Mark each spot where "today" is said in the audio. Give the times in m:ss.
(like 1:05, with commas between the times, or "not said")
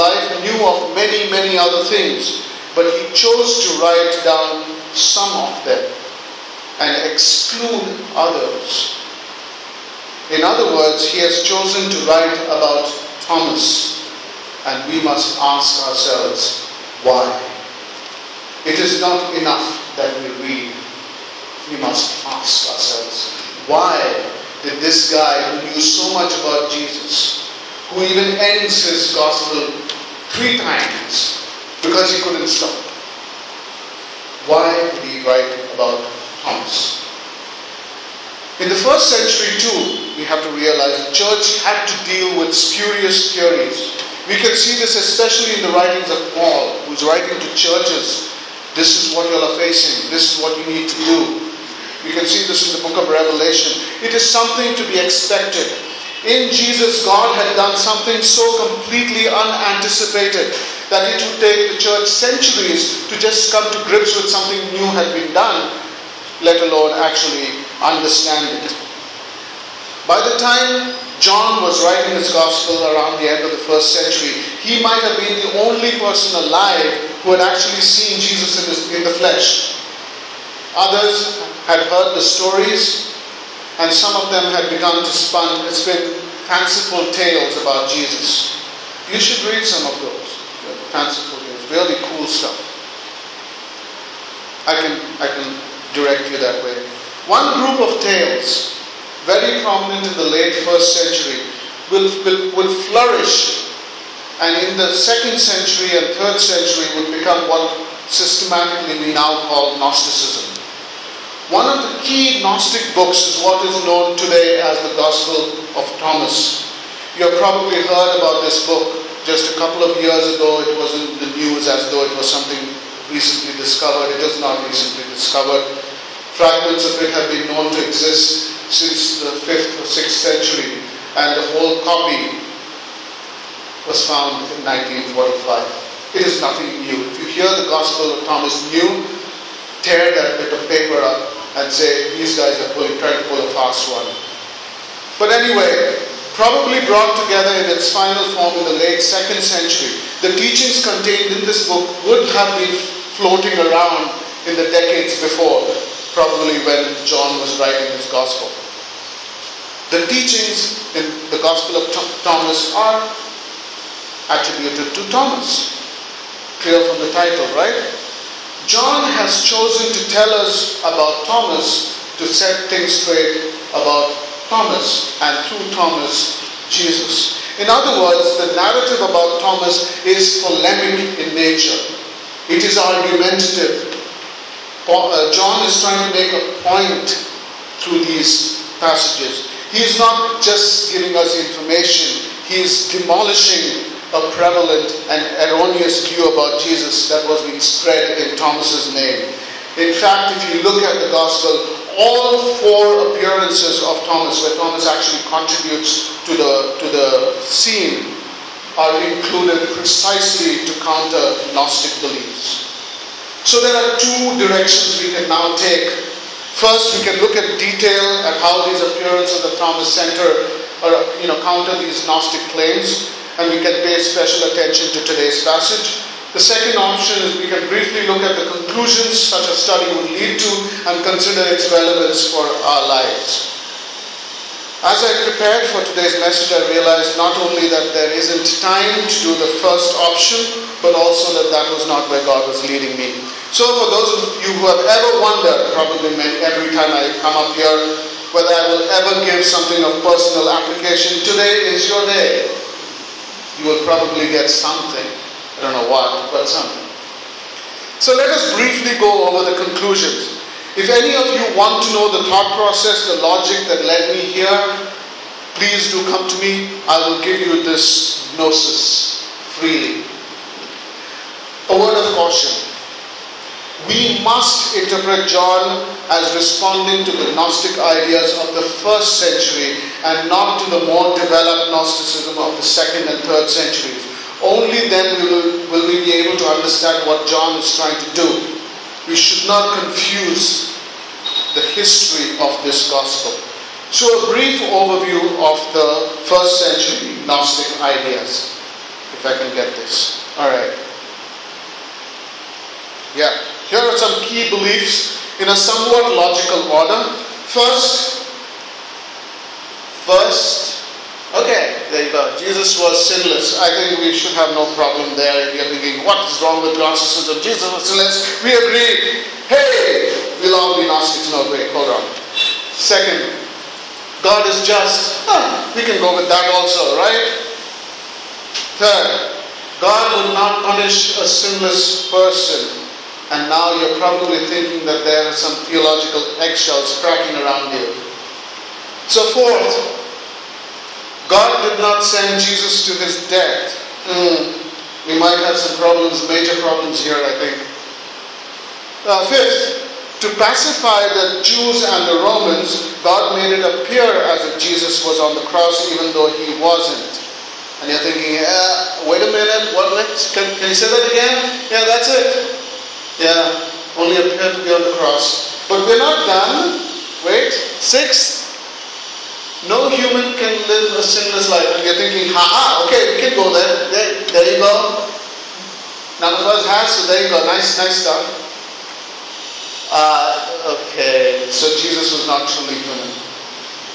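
1:54, 3:45, 3:55, 4:11.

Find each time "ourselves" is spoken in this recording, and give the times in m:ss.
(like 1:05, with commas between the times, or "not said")
0:15, 0:22.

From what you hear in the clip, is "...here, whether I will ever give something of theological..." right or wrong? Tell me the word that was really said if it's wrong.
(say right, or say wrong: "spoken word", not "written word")
wrong: "personal", not "theological".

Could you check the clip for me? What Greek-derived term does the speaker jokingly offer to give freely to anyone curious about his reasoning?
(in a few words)
gnosis.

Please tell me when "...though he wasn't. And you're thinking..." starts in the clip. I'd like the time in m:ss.
5:56.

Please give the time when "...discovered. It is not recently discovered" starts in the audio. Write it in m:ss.
2:03.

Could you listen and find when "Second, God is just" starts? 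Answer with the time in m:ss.
5:22.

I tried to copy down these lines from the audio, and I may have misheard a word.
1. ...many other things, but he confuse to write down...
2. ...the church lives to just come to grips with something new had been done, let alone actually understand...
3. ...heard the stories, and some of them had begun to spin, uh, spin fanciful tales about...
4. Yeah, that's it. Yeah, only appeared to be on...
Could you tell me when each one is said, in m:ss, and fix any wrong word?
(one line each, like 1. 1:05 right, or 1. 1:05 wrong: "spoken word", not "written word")
1. 0:01 wrong: "chose", not "confuse"
2. 1:01 wrong: "centuries", not "lives"
3. 1:21 right
4. 6:01 right.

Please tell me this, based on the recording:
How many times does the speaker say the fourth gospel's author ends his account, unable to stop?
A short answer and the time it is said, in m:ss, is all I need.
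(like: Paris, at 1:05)
3, at 0:30.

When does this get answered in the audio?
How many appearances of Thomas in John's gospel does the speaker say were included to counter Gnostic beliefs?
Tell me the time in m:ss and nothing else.
3:22.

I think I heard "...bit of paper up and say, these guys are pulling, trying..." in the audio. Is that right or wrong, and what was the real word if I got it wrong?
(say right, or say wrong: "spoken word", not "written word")
right.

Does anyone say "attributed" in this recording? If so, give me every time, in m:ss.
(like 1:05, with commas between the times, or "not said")
2:44.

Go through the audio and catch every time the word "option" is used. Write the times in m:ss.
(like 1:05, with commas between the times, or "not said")
3:46, 4:00.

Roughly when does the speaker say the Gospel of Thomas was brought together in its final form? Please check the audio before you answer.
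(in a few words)
late 2nd century.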